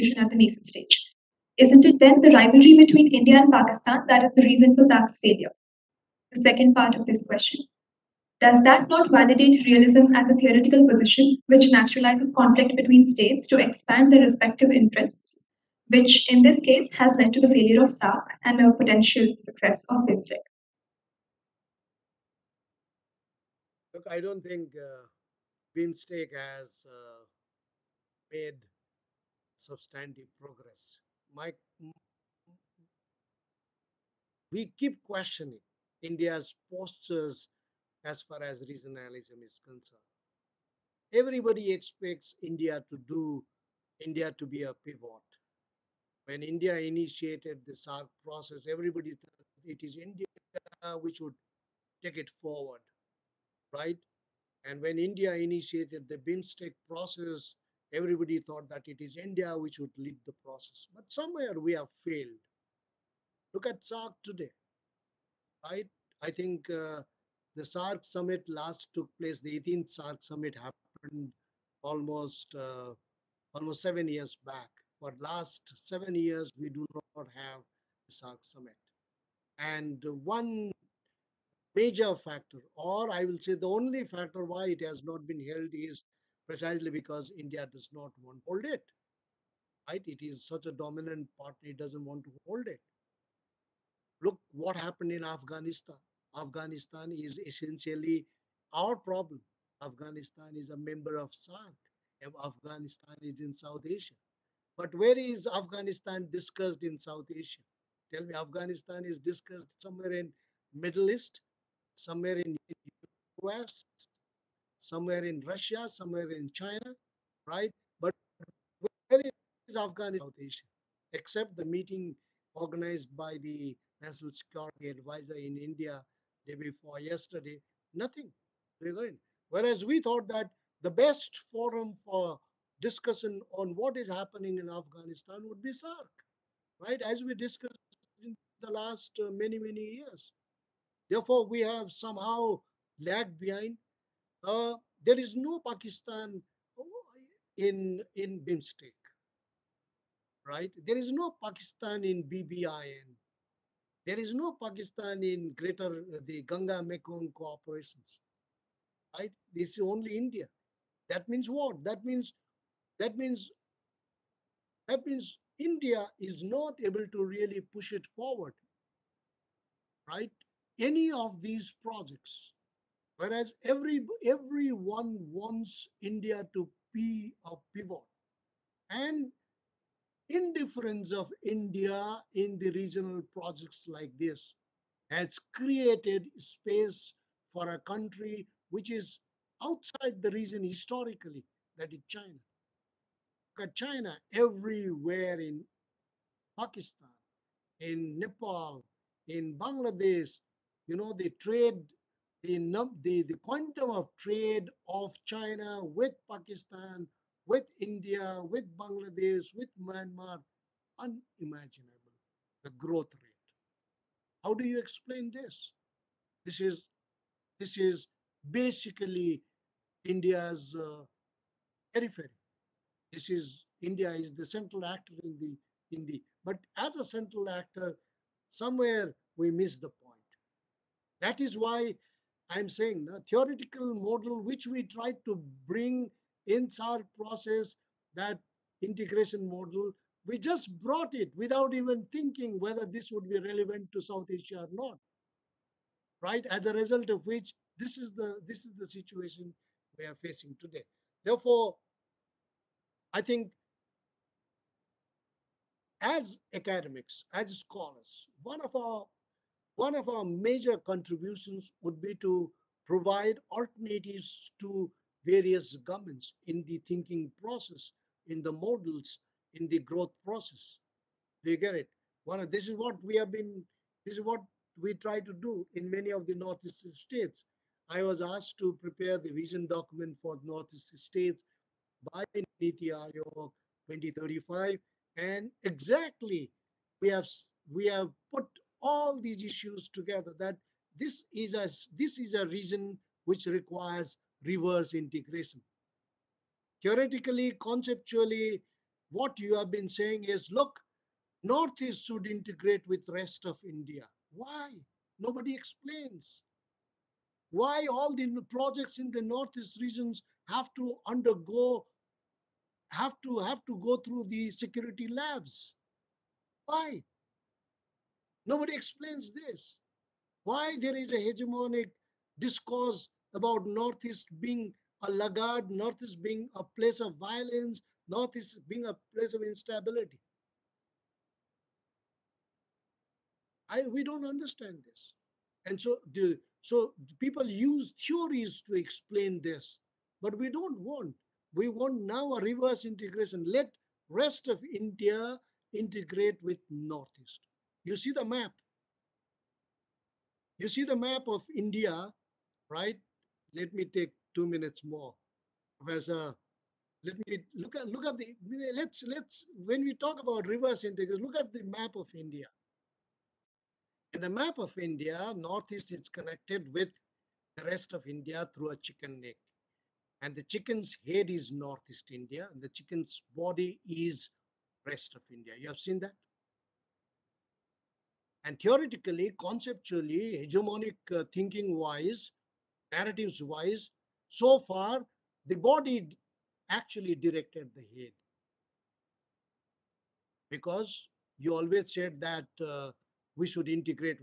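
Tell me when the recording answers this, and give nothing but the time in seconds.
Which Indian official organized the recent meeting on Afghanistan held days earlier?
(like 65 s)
124 s.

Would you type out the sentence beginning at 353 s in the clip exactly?
Let me take two minutes more.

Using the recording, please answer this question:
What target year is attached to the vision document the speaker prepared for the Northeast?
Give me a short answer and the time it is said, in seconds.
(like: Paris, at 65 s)
2035, at 283 s.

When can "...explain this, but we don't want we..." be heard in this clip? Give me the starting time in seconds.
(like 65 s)
338 s.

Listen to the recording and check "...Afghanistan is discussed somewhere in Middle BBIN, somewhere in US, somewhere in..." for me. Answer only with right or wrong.
wrong.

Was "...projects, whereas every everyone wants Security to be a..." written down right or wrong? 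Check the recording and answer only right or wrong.
wrong.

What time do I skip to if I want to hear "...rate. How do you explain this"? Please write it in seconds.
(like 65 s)
213 s.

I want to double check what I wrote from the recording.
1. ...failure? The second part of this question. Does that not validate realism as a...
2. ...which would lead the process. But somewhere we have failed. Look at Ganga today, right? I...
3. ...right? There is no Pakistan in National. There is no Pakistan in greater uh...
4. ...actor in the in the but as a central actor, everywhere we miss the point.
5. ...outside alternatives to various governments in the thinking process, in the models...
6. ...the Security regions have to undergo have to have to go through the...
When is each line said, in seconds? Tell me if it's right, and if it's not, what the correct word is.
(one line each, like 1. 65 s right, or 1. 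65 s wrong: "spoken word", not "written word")
1. 5 s right
2. 59 s wrong: "SAARC", not "Ganga"
3. 150 s wrong: "BBIN", not "National"
4. 224 s wrong: "somewhere", not "everywhere"
5. 262 s wrong: "provide", not "outside"
6. 309 s wrong: "Northeast", not "Security".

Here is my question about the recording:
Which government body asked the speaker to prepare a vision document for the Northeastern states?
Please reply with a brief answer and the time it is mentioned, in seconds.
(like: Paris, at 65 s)
Niti Aayog, at 282 s.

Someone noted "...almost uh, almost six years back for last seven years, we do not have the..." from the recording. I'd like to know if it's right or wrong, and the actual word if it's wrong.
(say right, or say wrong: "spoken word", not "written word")
wrong: "seven", not "six".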